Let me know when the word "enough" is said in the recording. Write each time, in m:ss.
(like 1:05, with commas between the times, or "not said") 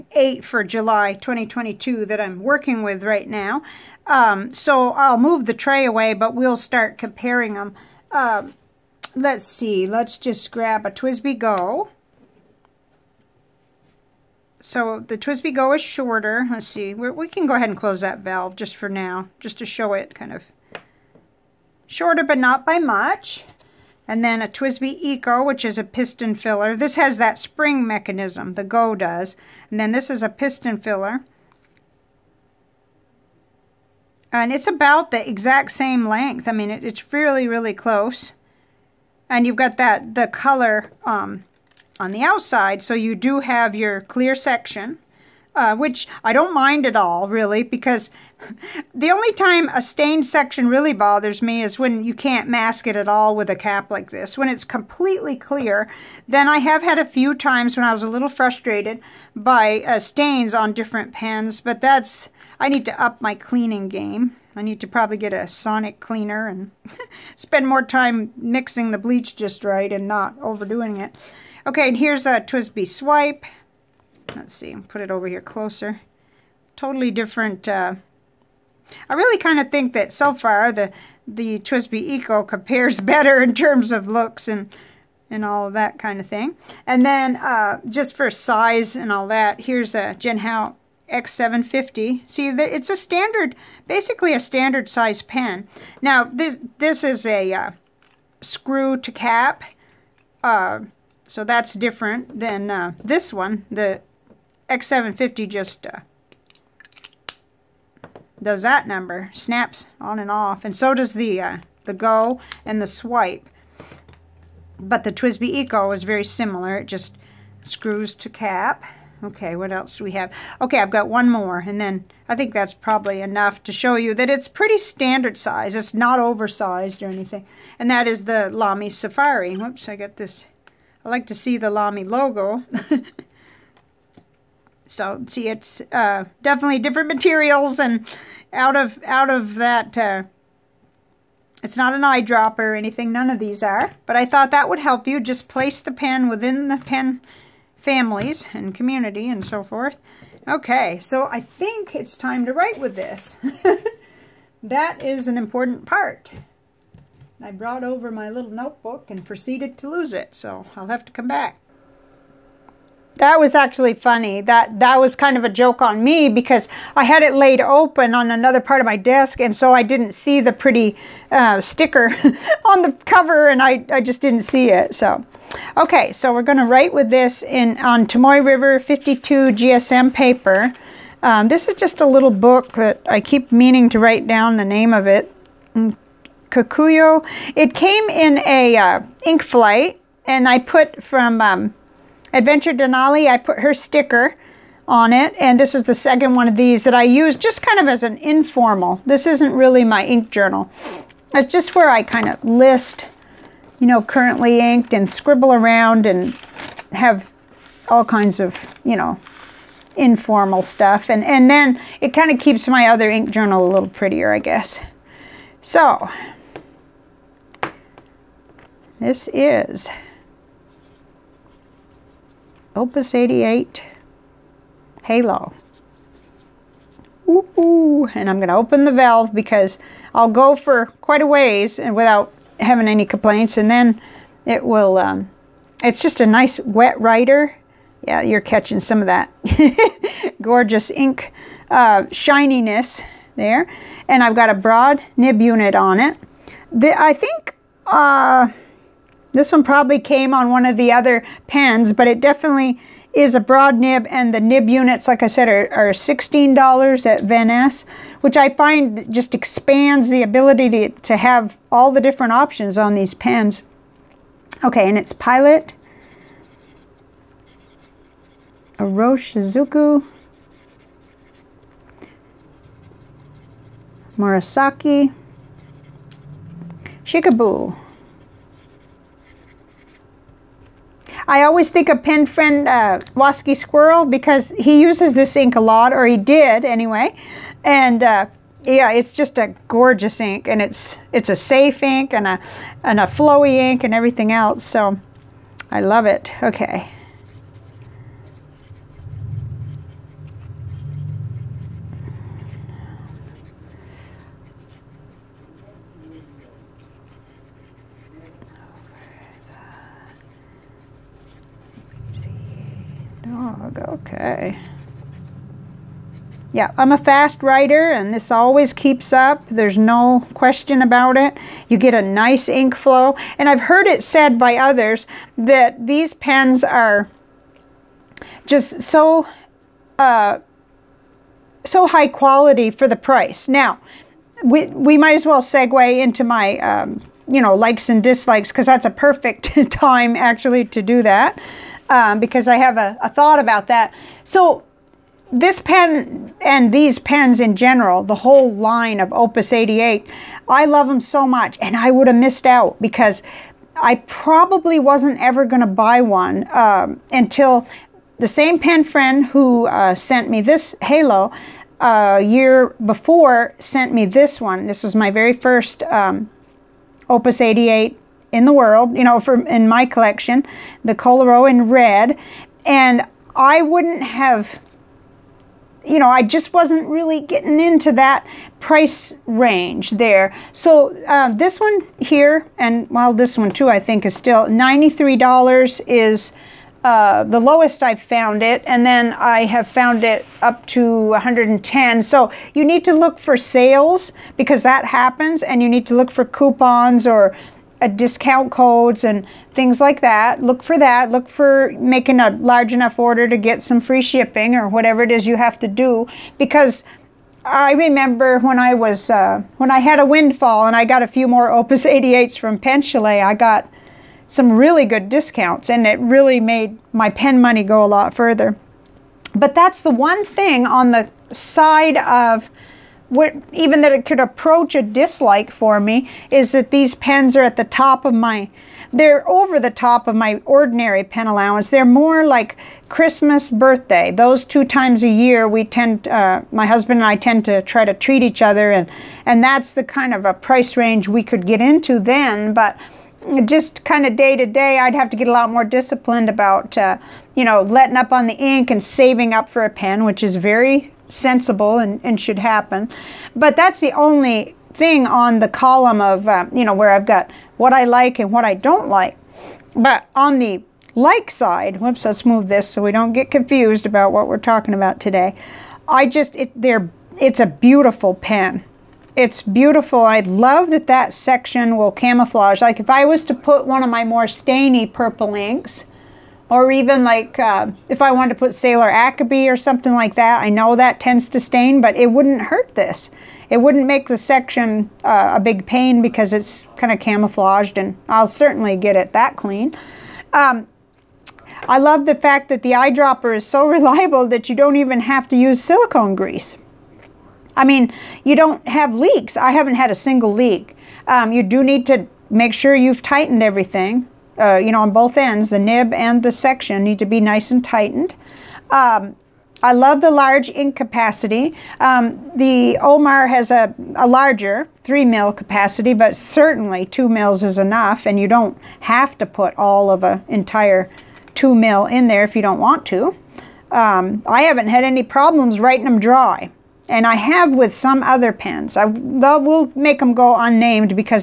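2:03, 6:42, 8:37.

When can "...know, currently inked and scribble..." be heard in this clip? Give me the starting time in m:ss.
3:23.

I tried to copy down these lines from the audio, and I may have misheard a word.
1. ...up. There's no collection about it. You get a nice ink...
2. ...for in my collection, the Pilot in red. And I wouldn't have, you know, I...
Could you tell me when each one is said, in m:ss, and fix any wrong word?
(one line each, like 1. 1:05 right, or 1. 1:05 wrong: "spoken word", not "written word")
1. 5:19 wrong: "question", not "collection"
2. 6:09 wrong: "Koloro", not "Pilot".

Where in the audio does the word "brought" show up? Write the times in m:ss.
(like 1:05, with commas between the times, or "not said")
2:37.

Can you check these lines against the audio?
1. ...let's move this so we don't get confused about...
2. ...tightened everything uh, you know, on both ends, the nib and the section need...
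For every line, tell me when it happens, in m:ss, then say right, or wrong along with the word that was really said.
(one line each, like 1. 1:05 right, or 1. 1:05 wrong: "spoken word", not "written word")
1. 7:42 right
2. 8:23 right.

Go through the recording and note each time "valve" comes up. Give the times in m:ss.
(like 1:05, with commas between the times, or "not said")
0:18, 3:48.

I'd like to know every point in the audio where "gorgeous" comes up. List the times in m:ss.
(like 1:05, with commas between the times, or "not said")
4:00, 4:49.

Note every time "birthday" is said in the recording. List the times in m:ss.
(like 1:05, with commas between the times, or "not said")
7:13.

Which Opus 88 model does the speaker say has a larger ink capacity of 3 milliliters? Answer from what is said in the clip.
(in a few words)
Omar.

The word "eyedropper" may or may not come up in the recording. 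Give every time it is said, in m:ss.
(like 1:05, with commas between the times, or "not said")
2:22, 8:12.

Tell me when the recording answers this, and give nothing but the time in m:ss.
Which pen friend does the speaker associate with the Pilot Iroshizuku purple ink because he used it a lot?
4:43.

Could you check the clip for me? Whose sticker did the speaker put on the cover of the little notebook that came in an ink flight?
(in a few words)
Adventure Denali.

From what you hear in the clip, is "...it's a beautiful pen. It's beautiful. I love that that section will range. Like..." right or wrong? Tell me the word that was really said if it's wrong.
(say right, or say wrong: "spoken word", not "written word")
wrong: "camouflage", not "range".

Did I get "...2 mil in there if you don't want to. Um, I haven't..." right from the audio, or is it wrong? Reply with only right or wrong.
right.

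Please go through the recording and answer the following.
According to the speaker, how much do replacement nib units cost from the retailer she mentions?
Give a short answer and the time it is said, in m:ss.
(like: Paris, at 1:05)
$16, at 4:15.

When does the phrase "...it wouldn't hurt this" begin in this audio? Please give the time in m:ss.
8:01.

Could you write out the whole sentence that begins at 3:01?
Um, this is just a little book that I keep meaning to write down the name of it.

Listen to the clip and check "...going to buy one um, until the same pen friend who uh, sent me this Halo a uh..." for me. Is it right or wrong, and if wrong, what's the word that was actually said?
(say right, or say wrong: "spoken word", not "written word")
right.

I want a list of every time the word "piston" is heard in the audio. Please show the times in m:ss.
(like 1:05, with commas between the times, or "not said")
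0:25, 0:30.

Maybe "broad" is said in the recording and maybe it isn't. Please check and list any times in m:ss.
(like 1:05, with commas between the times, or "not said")
4:04, 4:13.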